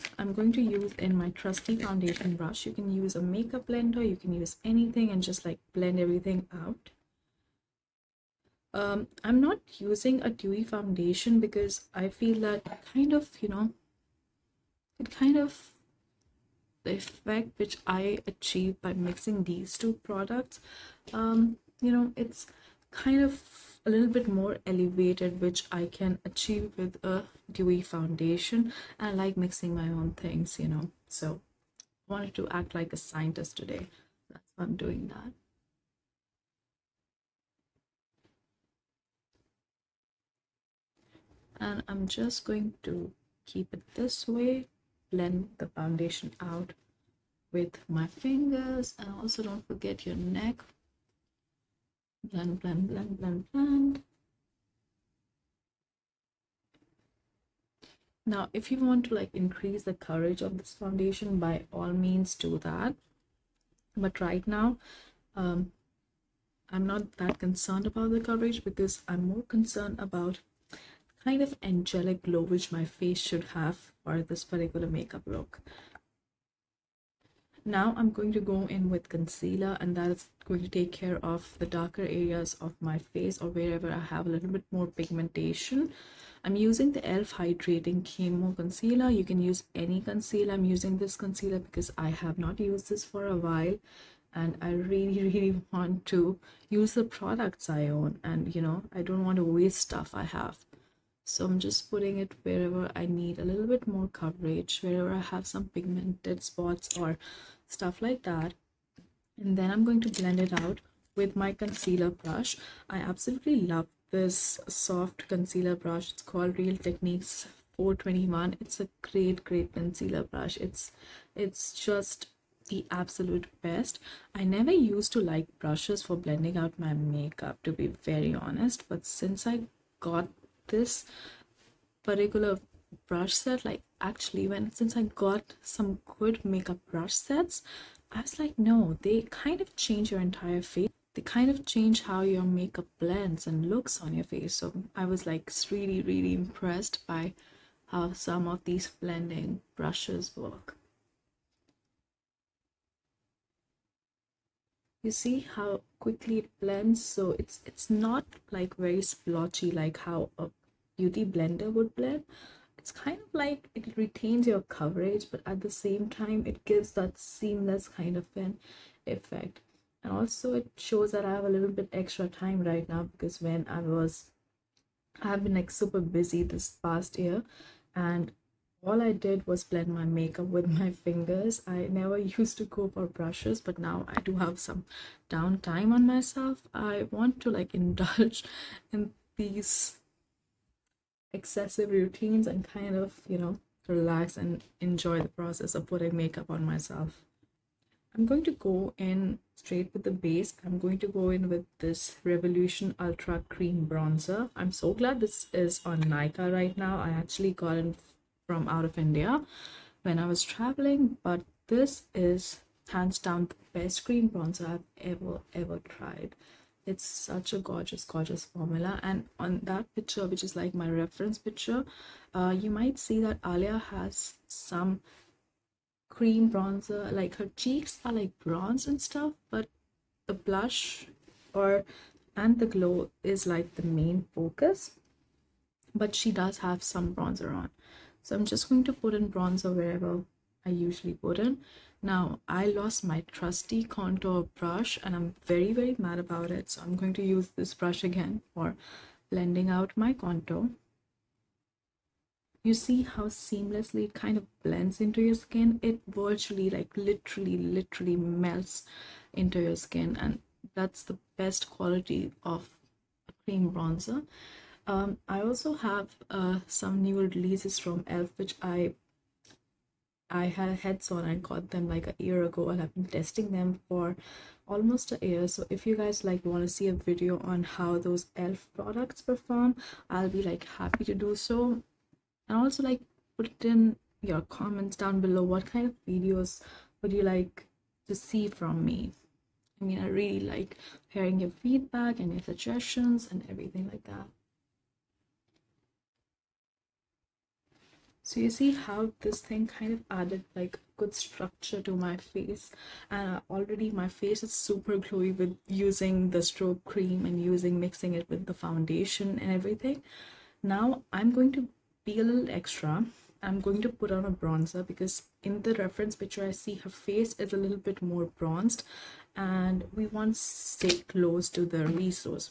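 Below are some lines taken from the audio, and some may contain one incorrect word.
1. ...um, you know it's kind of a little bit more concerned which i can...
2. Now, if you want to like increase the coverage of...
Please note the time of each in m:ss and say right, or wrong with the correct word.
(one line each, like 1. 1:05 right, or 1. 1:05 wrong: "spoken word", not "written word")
1. 0:21 wrong: "elevated", not "concerned"
2. 0:58 right.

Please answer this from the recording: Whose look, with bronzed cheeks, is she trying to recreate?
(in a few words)
Alia.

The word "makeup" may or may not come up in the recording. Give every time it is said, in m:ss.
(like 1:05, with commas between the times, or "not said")
0:03, 1:14, 2:06, 2:16, 2:22, 3:00, 3:16.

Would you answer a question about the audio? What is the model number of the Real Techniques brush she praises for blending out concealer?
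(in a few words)
421.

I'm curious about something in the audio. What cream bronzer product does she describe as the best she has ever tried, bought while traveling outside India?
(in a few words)
Revolution Ultra Cream Bronzer.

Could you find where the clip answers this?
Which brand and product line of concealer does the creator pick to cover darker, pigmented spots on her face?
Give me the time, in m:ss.
1:27.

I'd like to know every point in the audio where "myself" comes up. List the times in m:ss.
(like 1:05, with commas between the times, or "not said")
3:06, 3:16.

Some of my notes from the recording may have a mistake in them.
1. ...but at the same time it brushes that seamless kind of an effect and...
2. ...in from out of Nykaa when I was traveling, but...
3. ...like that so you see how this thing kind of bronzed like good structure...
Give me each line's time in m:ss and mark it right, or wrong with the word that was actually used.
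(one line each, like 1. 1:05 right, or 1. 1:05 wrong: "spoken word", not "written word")
1. 2:45 wrong: "gives", not "brushes"
2. 3:27 wrong: "India", not "Nykaa"
3. 4:53 wrong: "added", not "bronzed".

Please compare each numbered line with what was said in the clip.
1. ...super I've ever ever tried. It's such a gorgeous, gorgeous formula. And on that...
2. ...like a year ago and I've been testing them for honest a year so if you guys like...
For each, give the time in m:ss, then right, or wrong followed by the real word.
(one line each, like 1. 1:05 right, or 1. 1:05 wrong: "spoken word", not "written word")
1. 3:34 wrong: "bronzer", not "super"
2. 4:31 wrong: "almost", not "honest".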